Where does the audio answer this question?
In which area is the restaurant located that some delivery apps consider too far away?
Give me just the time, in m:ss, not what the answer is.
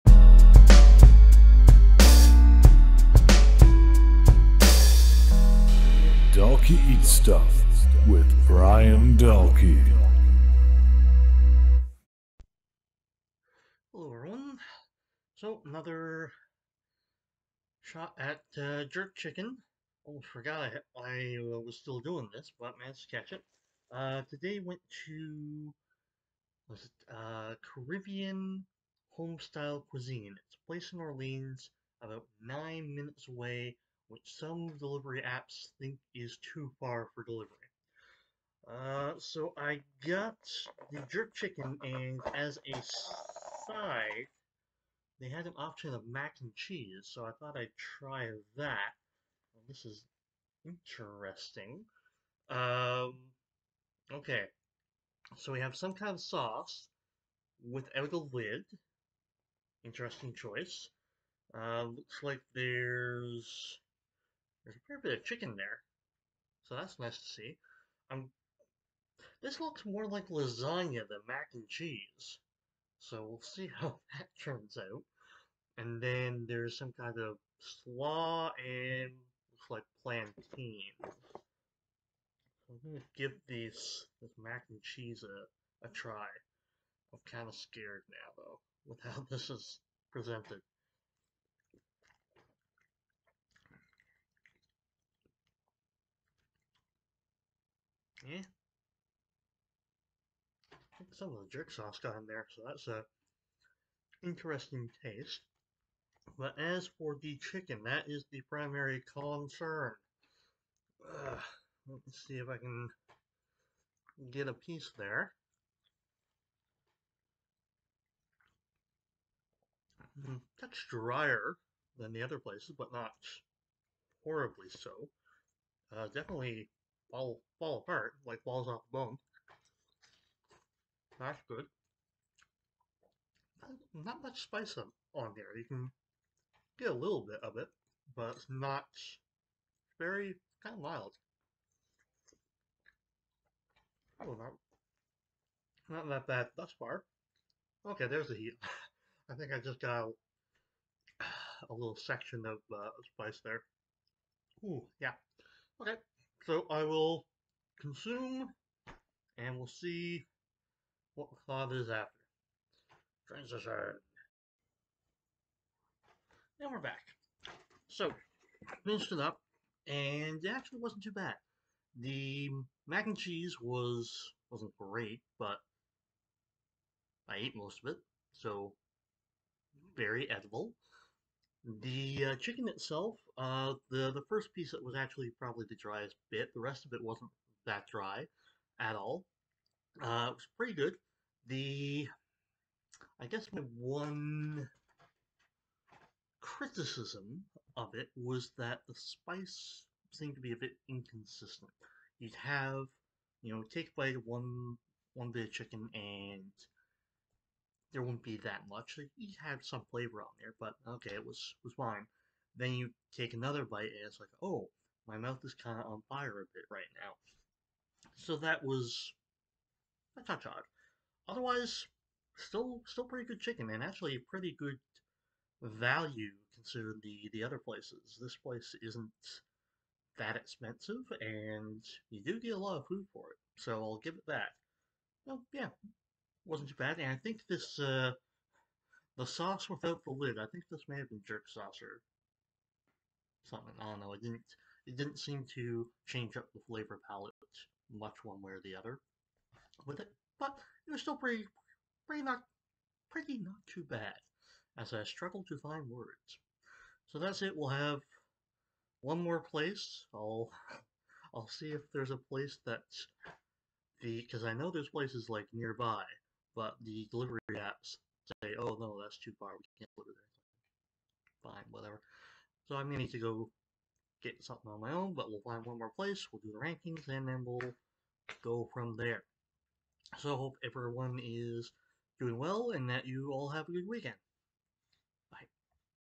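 0:31.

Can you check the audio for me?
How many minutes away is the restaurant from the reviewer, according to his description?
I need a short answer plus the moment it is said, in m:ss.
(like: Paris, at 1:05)
9, at 0:32.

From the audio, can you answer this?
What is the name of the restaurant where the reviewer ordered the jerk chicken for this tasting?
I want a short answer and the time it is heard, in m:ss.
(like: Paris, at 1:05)
Caribbean Home Style Cuisine, at 0:27.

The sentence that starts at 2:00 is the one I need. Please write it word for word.
Mm, that's drier than the other places, but not horribly so.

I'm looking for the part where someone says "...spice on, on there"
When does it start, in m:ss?
2:14.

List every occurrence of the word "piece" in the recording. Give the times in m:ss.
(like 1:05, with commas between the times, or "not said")
1:54, 3:04.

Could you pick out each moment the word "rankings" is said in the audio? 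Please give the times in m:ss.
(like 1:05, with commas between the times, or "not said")
4:36.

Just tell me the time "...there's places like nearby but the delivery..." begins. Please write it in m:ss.
4:24.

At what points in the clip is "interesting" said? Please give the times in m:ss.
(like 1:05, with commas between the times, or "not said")
0:50, 0:59, 1:44.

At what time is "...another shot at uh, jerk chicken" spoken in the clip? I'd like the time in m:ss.
0:15.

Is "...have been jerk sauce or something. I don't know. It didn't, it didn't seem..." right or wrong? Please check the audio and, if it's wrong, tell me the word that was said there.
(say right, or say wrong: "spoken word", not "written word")
right.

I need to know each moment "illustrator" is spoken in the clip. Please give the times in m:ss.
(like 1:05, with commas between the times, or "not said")
not said.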